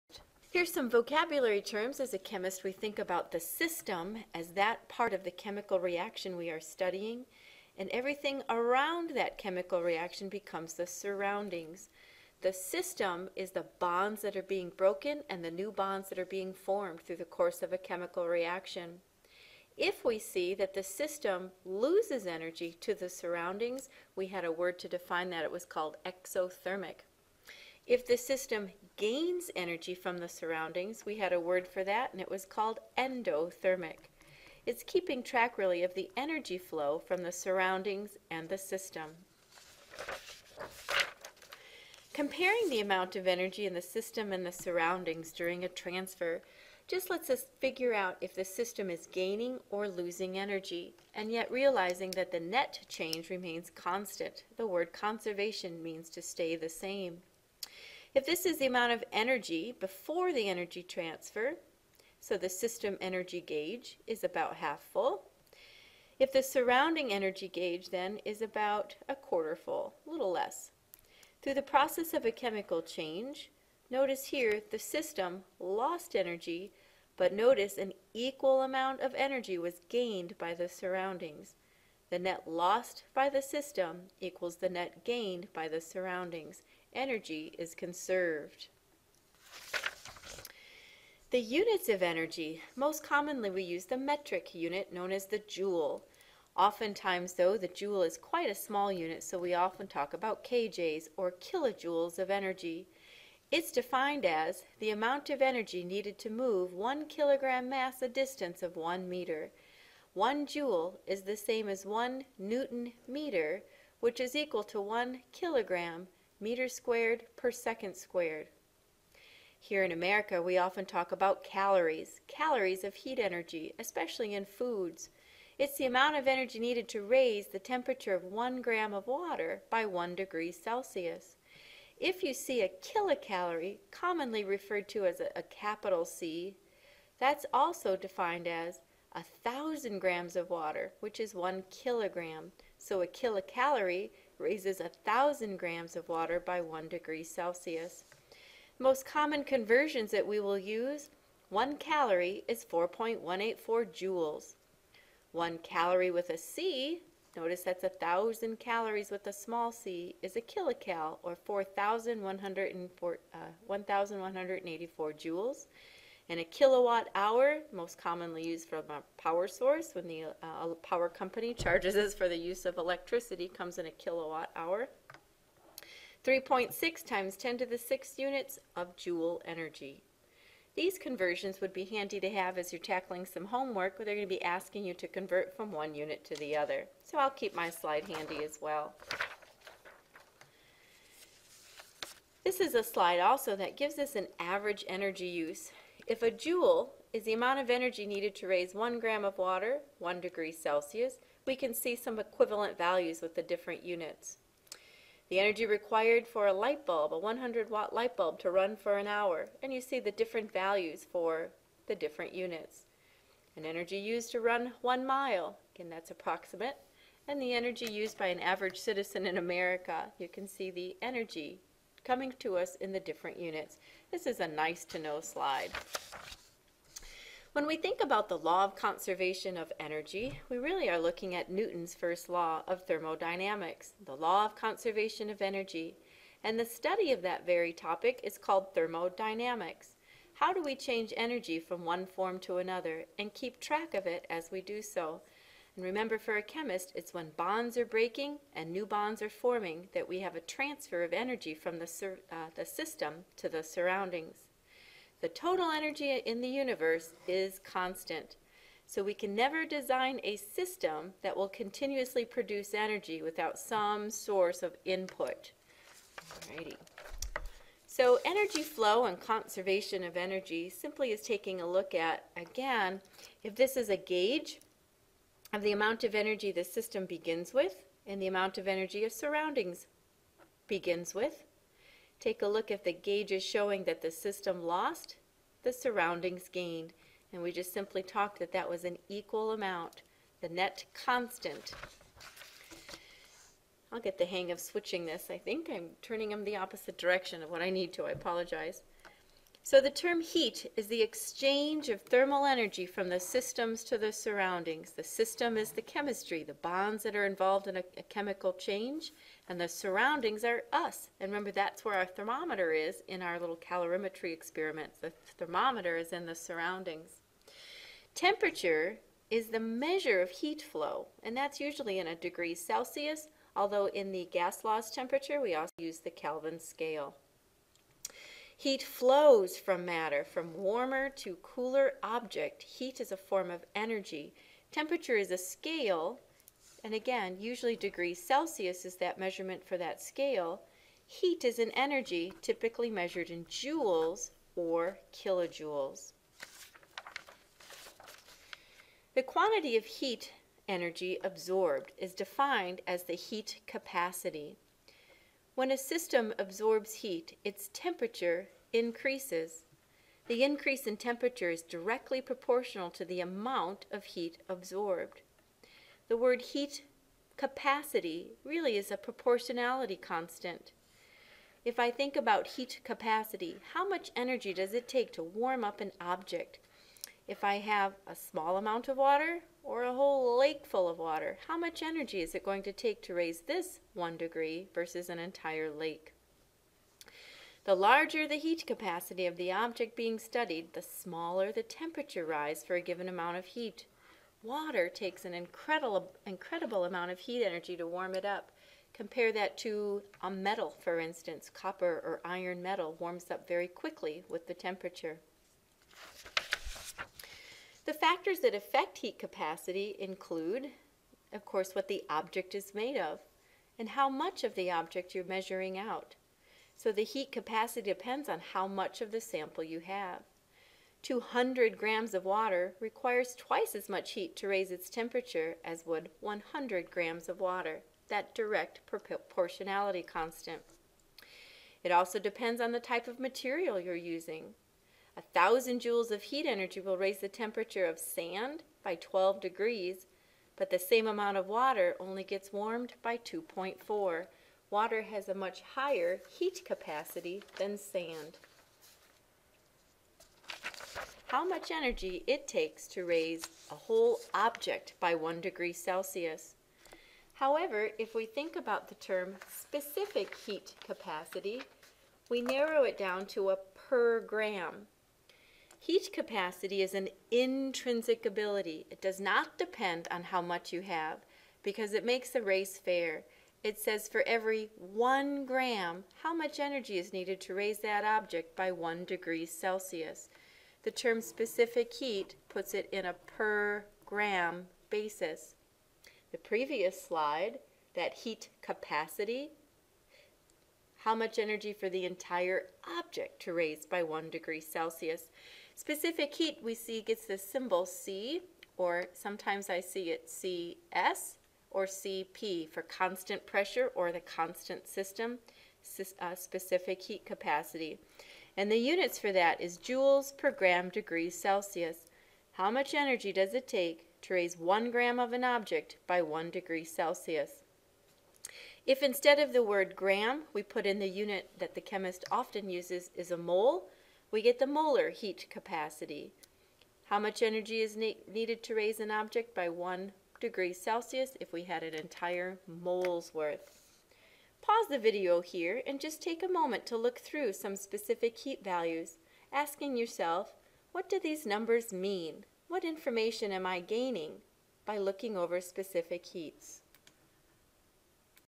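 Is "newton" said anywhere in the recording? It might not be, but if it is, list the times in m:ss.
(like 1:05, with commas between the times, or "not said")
1:52, 3:51.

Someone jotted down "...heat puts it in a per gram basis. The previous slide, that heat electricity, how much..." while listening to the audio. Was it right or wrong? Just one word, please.
wrong.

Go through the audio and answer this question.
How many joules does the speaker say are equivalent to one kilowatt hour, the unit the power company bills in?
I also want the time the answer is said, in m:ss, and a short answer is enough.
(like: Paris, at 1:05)
3.6 × 10^6, at 2:56.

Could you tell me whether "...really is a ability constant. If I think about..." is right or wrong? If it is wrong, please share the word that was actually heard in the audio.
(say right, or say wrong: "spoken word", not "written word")
wrong: "proportionality", not "ability".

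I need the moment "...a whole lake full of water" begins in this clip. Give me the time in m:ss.
6:19.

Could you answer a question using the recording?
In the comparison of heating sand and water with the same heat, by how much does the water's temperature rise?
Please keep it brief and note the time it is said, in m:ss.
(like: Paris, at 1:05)
2.4, at 7:23.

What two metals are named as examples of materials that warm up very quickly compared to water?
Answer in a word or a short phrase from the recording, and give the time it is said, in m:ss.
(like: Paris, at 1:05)
copper or iron, at 6:41.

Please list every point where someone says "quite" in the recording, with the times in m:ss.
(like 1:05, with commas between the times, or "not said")
1:38.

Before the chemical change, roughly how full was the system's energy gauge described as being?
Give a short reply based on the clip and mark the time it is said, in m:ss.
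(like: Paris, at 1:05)
half full, at 1:04.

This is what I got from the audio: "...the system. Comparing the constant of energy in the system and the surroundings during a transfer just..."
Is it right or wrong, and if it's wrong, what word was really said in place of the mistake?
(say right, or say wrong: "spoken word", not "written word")
wrong: "amount", not "constant".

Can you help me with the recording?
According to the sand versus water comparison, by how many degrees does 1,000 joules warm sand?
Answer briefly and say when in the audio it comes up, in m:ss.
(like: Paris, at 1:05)
12 degrees, at 7:18.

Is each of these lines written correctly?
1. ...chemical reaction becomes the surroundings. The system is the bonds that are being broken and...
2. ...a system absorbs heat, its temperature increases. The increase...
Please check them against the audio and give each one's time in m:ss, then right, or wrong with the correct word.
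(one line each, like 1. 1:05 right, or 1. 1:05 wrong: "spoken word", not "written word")
1. 0:09 right
2. 5:55 right.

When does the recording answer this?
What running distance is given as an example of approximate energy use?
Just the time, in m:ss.
3:34.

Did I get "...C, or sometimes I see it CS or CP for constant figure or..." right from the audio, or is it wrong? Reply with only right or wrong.
wrong.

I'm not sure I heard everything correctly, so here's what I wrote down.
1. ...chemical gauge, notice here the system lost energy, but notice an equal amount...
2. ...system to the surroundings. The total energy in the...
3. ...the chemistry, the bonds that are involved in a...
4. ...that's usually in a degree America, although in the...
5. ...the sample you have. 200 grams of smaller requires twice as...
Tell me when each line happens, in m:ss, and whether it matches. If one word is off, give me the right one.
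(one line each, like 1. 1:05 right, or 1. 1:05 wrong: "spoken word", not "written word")
1. 1:12 wrong: "change", not "gauge"
2. 4:12 right
3. 5:05 right
4. 5:21 wrong: "Celsius", not "America"
5. 6:59 wrong: "water", not "smaller".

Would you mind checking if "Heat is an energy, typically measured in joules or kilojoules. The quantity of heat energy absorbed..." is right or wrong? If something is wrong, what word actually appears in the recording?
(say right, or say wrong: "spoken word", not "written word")
right.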